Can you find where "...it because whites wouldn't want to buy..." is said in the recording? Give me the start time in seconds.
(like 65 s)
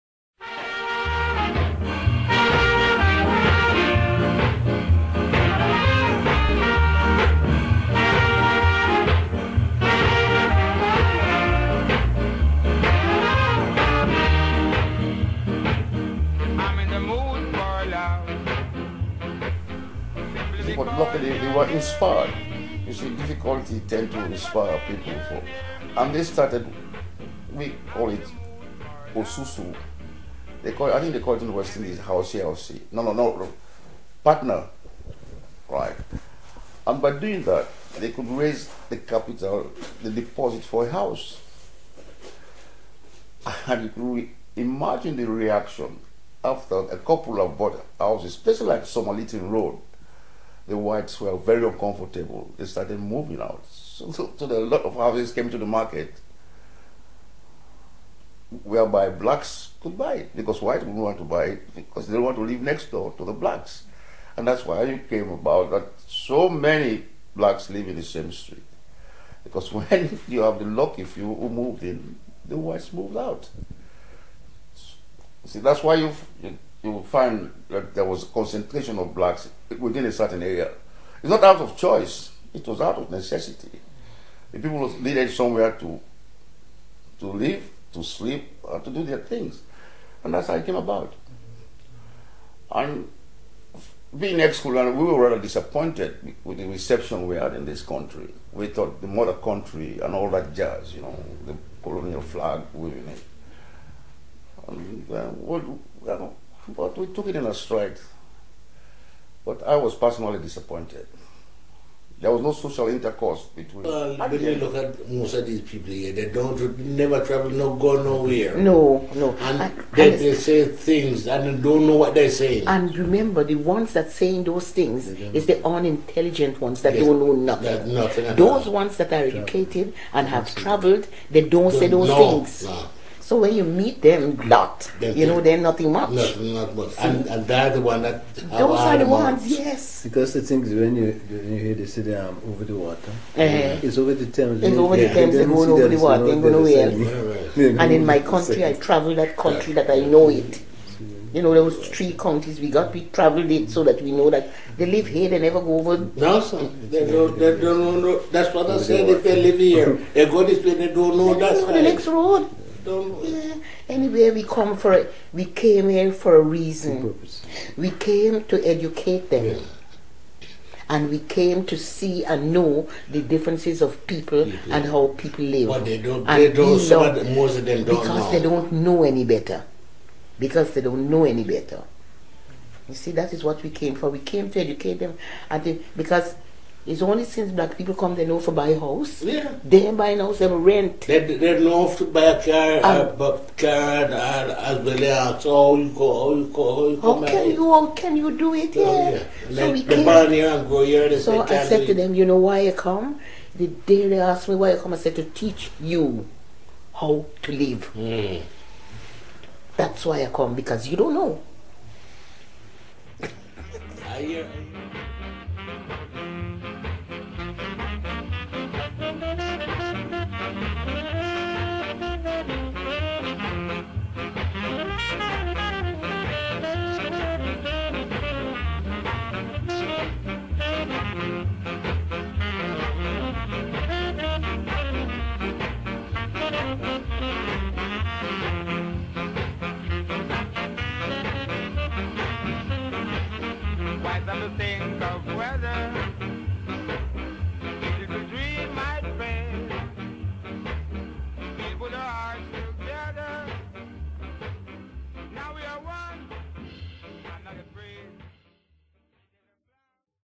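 60 s.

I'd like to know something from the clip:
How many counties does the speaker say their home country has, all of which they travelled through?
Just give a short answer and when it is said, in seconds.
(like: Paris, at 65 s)
3, at 151 s.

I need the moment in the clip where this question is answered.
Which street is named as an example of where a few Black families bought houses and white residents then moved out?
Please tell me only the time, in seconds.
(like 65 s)
48 s.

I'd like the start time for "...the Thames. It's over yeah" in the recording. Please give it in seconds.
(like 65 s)
144 s.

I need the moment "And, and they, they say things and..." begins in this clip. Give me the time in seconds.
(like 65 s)
119 s.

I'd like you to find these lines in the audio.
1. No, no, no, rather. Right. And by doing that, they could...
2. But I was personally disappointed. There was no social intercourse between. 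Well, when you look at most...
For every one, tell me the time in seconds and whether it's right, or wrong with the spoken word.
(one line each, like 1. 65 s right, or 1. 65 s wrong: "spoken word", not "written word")
1. 32 s wrong: "partner", not "rather"
2. 109 s right.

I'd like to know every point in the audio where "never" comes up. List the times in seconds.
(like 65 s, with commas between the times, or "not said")
116 s, 155 s.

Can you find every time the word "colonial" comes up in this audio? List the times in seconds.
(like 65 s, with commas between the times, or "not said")
94 s, 101 s.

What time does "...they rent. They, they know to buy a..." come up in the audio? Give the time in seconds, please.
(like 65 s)
190 s.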